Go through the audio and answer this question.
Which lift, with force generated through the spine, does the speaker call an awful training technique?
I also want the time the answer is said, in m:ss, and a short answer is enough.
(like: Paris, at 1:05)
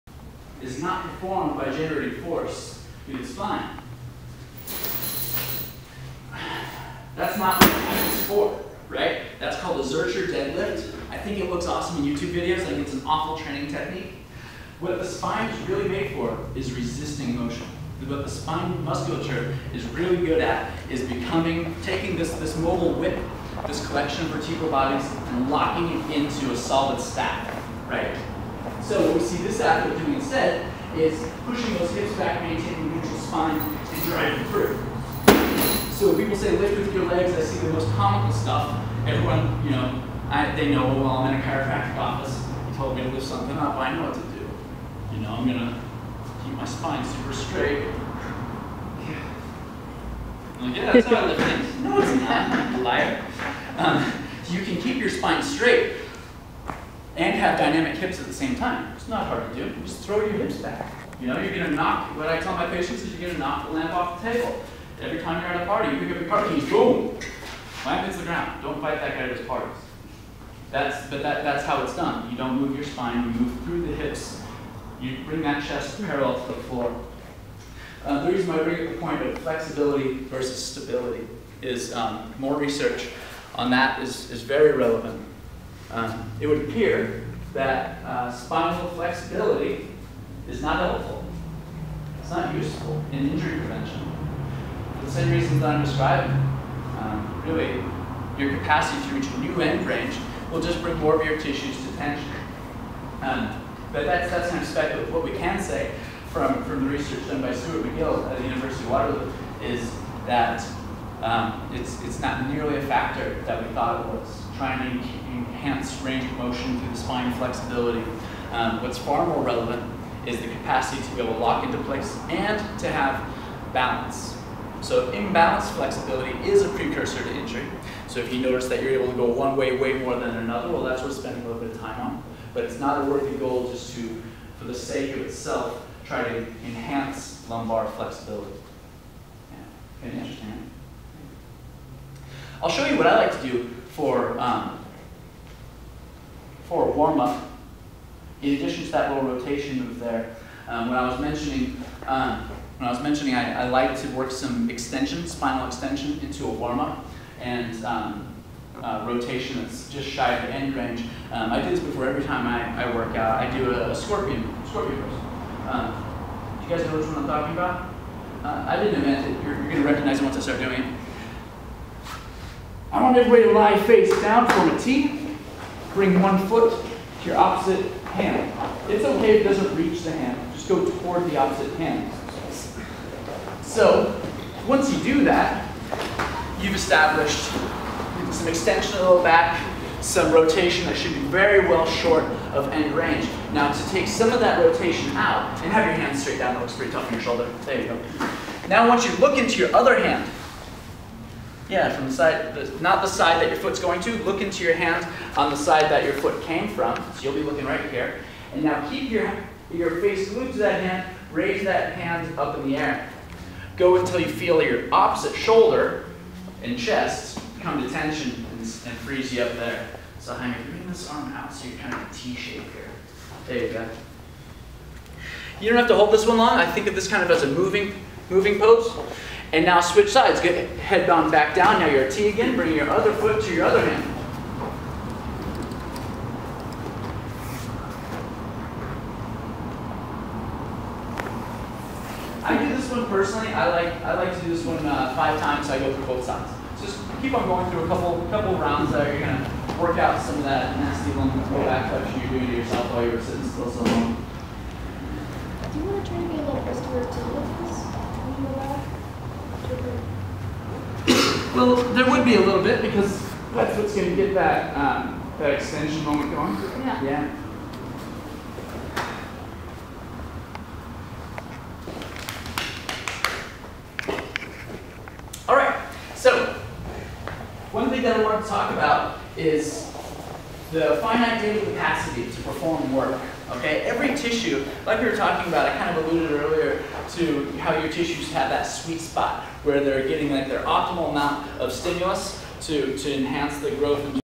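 Zercher deadlift, at 0:09.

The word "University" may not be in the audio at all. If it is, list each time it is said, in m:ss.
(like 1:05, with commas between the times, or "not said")
1:48.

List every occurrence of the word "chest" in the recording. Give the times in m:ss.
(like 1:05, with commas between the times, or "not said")
1:15, 3:36.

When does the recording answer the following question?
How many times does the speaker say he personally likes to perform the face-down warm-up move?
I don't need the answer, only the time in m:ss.
4:05.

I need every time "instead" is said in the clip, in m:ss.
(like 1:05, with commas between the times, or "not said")
0:30.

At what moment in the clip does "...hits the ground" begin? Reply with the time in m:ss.
1:08.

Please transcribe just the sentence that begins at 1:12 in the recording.
You don't move your spine, you move through the hips.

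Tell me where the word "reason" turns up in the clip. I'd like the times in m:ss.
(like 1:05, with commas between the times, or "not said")
1:18, 1:35.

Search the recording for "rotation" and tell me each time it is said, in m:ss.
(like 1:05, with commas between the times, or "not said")
2:29, 2:39, 3:10, 3:14.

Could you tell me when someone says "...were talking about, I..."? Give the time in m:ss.
4:45.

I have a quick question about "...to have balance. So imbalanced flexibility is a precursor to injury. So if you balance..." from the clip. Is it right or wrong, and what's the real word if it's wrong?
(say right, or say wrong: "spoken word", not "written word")
wrong: "notice", not "balance".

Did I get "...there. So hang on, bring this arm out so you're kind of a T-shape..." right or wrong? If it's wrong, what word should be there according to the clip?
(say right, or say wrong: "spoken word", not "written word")
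right.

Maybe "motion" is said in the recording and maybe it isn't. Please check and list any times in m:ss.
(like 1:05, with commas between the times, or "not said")
0:17, 1:56.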